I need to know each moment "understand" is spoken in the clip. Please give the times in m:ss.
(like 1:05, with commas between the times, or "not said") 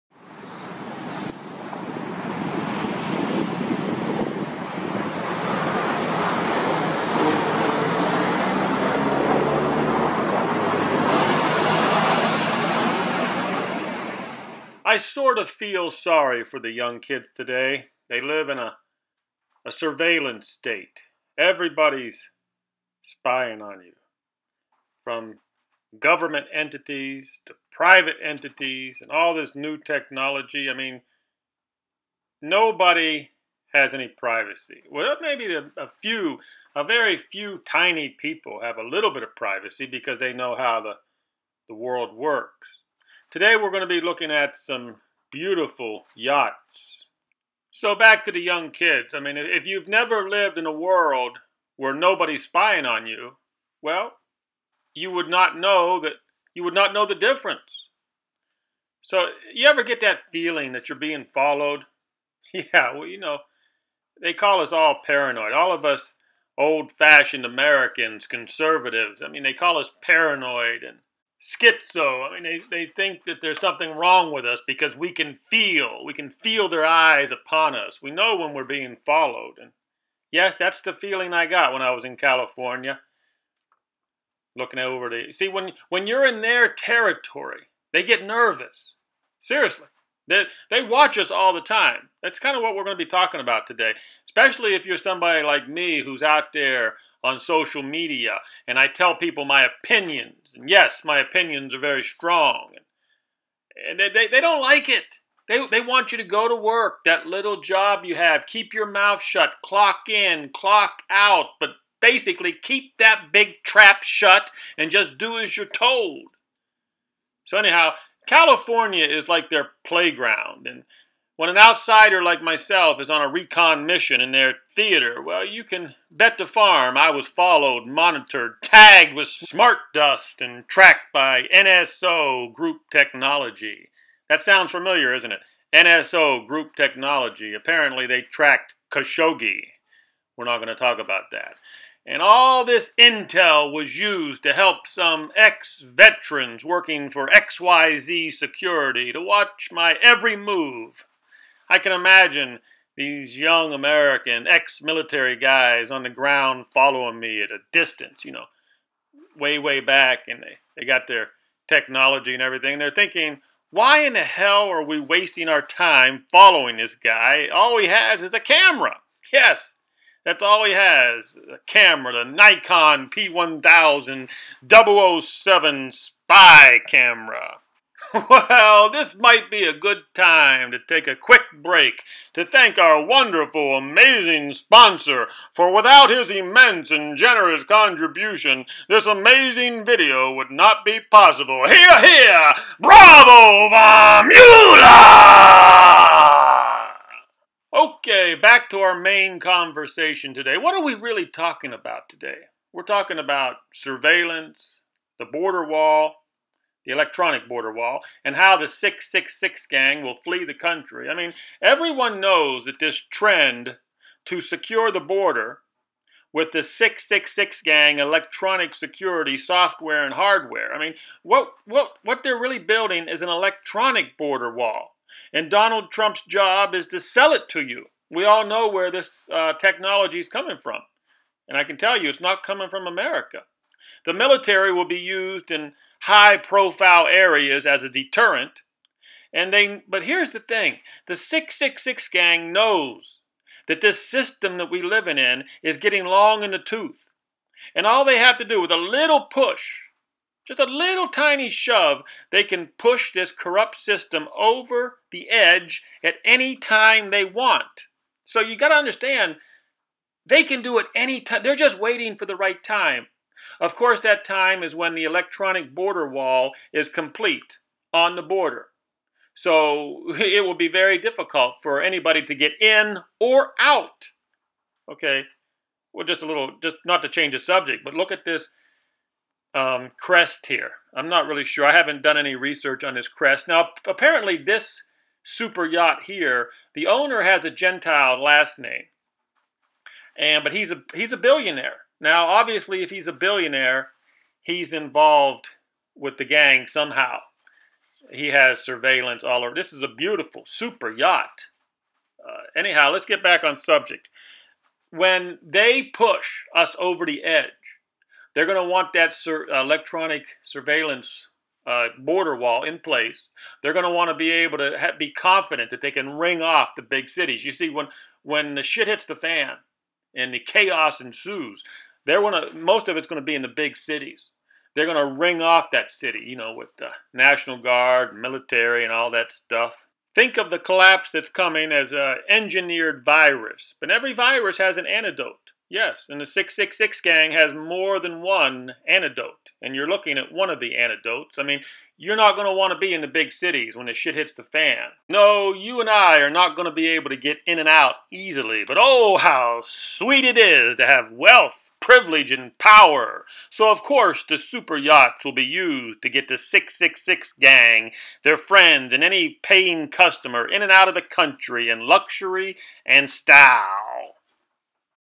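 4:18.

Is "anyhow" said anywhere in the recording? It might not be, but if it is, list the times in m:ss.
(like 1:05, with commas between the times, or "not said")
1:57, 5:02.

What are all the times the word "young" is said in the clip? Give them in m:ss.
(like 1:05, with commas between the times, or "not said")
0:16, 0:48, 2:33.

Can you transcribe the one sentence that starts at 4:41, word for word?
I haven't done any research on this crest.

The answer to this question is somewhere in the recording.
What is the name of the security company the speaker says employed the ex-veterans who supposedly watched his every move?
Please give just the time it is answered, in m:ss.
2:27.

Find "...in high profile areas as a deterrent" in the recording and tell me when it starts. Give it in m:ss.
3:55.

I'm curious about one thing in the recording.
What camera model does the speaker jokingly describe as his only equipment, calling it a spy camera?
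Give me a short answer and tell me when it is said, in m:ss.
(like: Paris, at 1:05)
Nikon P1000, at 2:52.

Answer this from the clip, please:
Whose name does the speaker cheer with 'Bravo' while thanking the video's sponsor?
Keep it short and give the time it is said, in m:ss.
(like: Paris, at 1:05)
Vamula, at 3:13.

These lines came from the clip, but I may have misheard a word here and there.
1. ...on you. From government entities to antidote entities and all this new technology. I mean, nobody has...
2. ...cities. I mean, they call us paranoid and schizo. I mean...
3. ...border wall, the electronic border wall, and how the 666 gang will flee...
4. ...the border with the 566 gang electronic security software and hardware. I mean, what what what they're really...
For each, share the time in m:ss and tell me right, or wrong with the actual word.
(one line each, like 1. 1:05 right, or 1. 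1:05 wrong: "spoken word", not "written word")
1. 0:23 wrong: "private", not "antidote"
2. 1:08 wrong: "conservatives", not "cities"
3. 3:25 right
4. 3:34 wrong: "666", not "566".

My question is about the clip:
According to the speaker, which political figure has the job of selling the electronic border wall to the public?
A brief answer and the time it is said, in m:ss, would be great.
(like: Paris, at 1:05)
Donald Trump, at 3:45.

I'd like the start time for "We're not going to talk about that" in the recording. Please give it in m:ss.
2:20.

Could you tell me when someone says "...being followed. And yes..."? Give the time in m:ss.
1:18.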